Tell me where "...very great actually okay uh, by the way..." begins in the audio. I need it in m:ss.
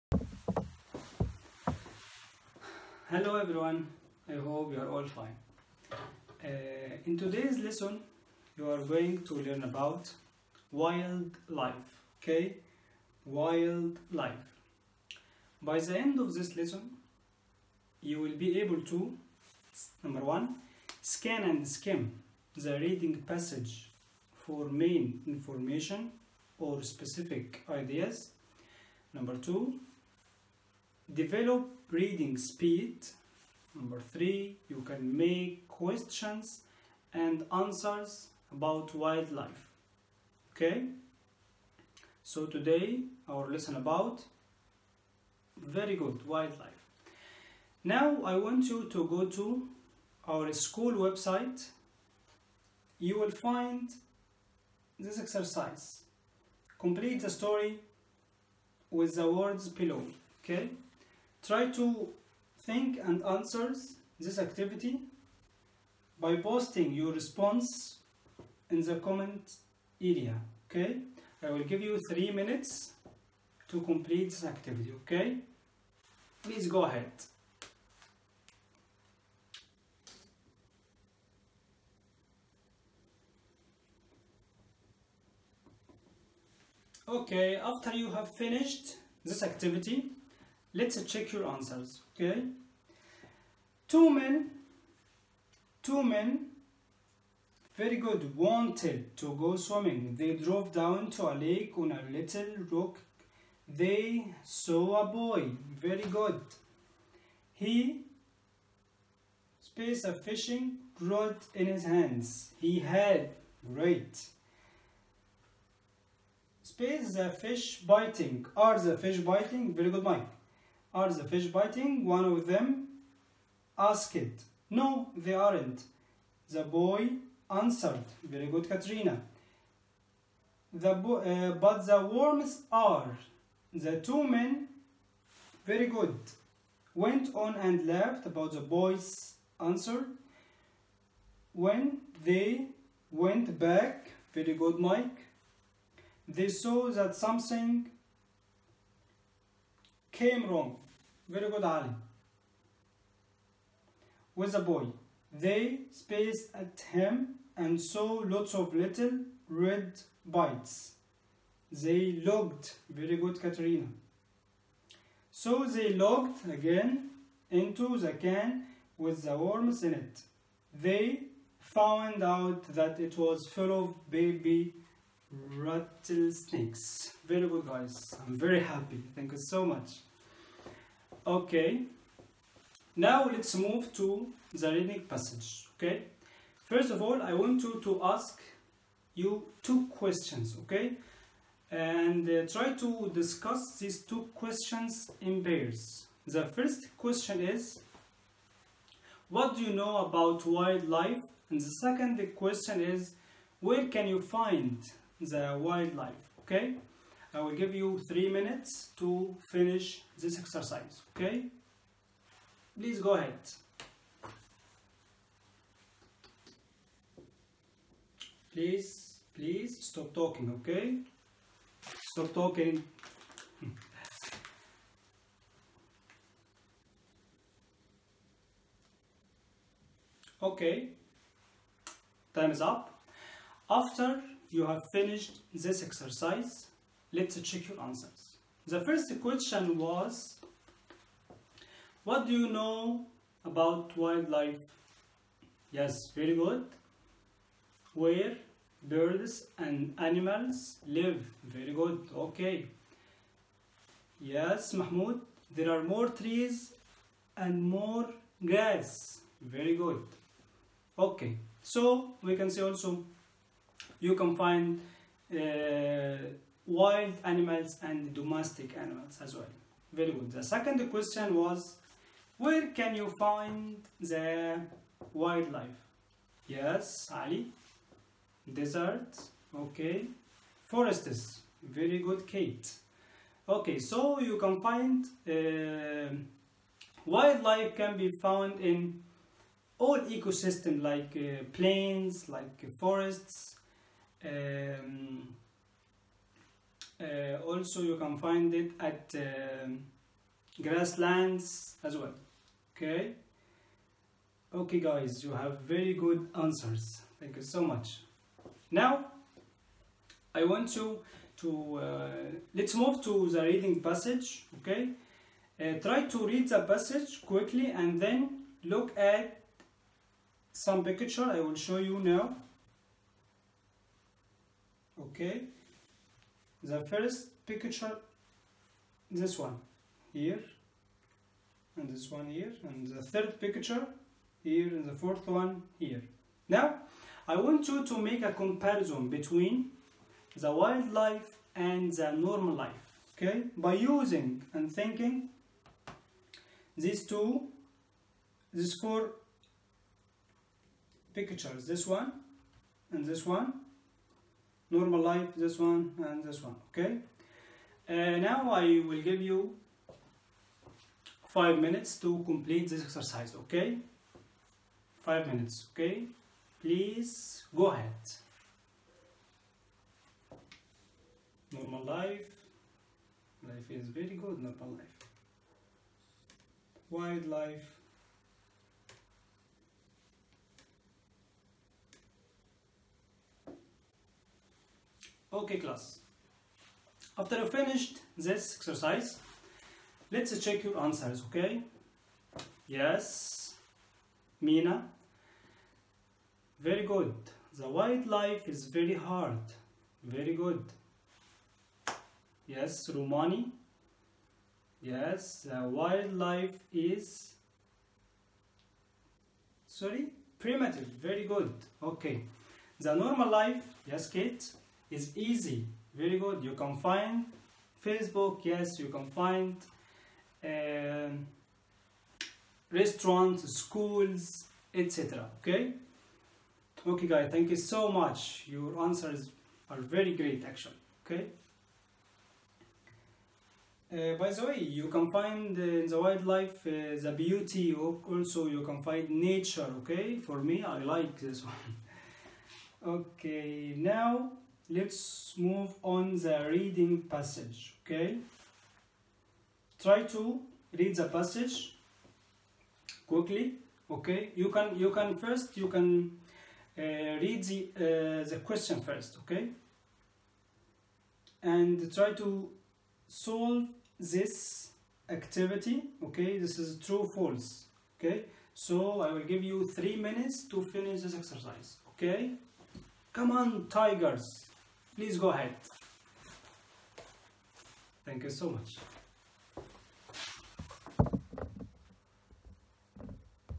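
7:09.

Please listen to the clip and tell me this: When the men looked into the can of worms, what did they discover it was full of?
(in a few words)
baby rattlesnakes.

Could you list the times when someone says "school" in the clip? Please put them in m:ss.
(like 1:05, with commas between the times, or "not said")
0:50, 7:03.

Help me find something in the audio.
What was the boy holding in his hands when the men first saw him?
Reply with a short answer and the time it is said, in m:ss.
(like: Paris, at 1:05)
a fishing rod, at 1:50.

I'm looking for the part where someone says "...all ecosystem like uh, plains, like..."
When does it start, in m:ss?
4:49.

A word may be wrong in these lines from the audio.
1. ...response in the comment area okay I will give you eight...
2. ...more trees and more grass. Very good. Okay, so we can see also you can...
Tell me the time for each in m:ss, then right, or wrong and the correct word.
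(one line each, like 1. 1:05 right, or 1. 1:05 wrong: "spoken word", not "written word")
1. 1:07 wrong: "three", not "eight"
2. 4:15 right.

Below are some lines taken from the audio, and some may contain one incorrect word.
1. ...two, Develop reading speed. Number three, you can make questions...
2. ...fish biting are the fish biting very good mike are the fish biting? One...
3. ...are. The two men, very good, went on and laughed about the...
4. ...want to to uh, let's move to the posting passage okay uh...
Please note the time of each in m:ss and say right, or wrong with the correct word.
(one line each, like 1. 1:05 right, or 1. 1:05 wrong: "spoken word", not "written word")
1. 0:29 right
2. 1:57 right
3. 2:12 right
4. 5:10 wrong: "reading", not "posting".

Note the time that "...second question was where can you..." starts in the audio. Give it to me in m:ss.
4:30.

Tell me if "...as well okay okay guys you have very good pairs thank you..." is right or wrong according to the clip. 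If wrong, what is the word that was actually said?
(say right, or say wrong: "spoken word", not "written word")
wrong: "answers", not "pairs".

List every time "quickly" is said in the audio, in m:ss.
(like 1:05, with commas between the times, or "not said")
5:17, 7:33.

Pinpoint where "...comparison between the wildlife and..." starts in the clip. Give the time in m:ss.
5:38.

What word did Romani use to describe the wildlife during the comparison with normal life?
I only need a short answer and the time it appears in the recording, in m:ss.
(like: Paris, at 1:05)
primitive, at 6:50.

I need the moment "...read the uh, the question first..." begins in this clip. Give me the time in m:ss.
7:37.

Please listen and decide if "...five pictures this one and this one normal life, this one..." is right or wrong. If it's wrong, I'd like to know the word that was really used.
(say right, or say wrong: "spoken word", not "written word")
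wrong: "four", not "five".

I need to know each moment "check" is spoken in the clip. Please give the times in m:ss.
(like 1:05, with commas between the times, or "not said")
1:31, 3:57, 6:30.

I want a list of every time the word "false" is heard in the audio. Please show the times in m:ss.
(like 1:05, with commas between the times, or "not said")
7:47.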